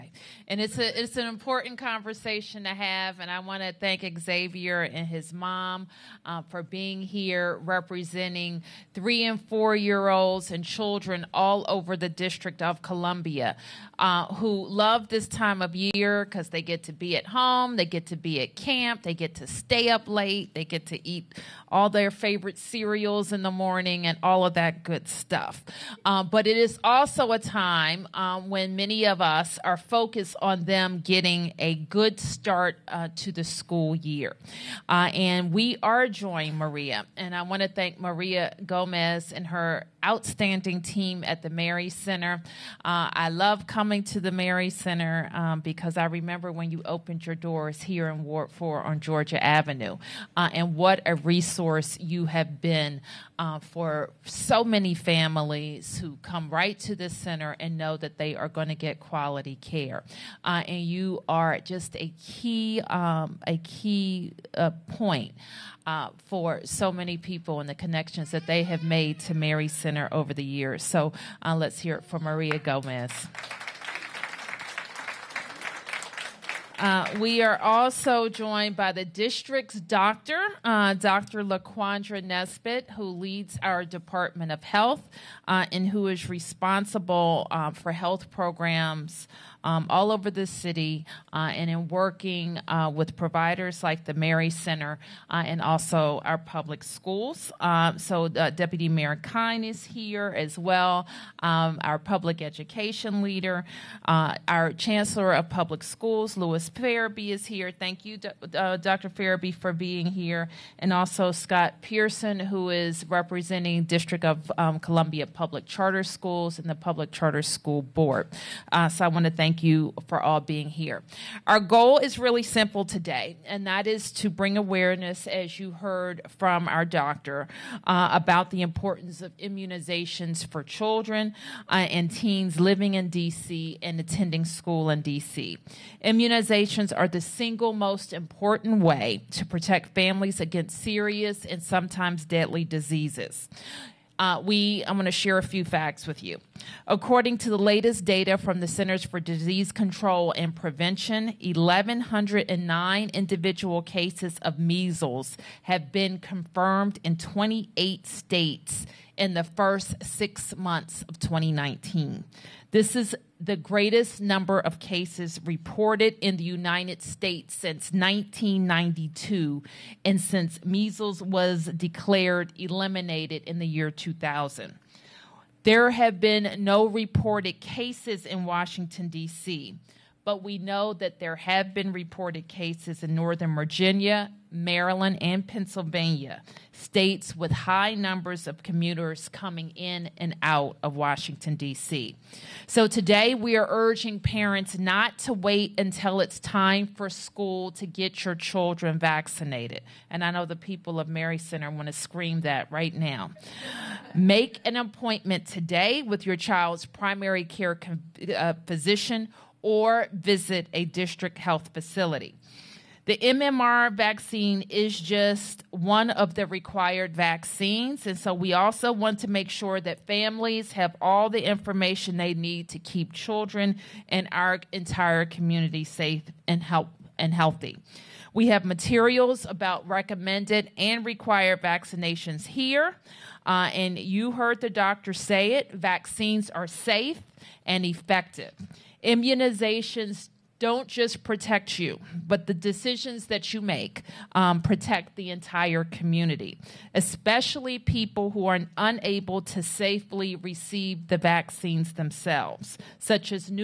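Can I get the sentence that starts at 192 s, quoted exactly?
So today we are urging parents not to wait until it's time for school to get your children vaccinated.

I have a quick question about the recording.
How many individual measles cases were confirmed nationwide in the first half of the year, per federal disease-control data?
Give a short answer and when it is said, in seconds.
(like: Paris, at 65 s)
1,109, at 151 s.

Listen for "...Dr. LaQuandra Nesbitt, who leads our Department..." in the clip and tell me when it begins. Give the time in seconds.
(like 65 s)
80 s.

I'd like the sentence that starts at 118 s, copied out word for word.
Uh, so I want to thank you for all being here.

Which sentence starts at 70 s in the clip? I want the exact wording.
So uh, let's hear it from Maria Gomez.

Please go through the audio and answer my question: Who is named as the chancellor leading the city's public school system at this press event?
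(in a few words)
Lewis Ferebee.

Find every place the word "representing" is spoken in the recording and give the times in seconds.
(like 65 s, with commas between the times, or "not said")
7 s, 113 s.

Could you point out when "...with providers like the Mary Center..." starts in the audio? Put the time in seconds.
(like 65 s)
92 s.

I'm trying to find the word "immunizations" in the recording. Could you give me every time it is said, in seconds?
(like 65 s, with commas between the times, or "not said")
129 s, 135 s, 239 s.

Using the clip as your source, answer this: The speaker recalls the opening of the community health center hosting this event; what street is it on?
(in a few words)
Georgia Avenue.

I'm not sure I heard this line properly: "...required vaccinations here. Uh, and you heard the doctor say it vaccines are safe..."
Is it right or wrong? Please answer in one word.
right.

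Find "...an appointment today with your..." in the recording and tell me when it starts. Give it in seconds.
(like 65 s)
204 s.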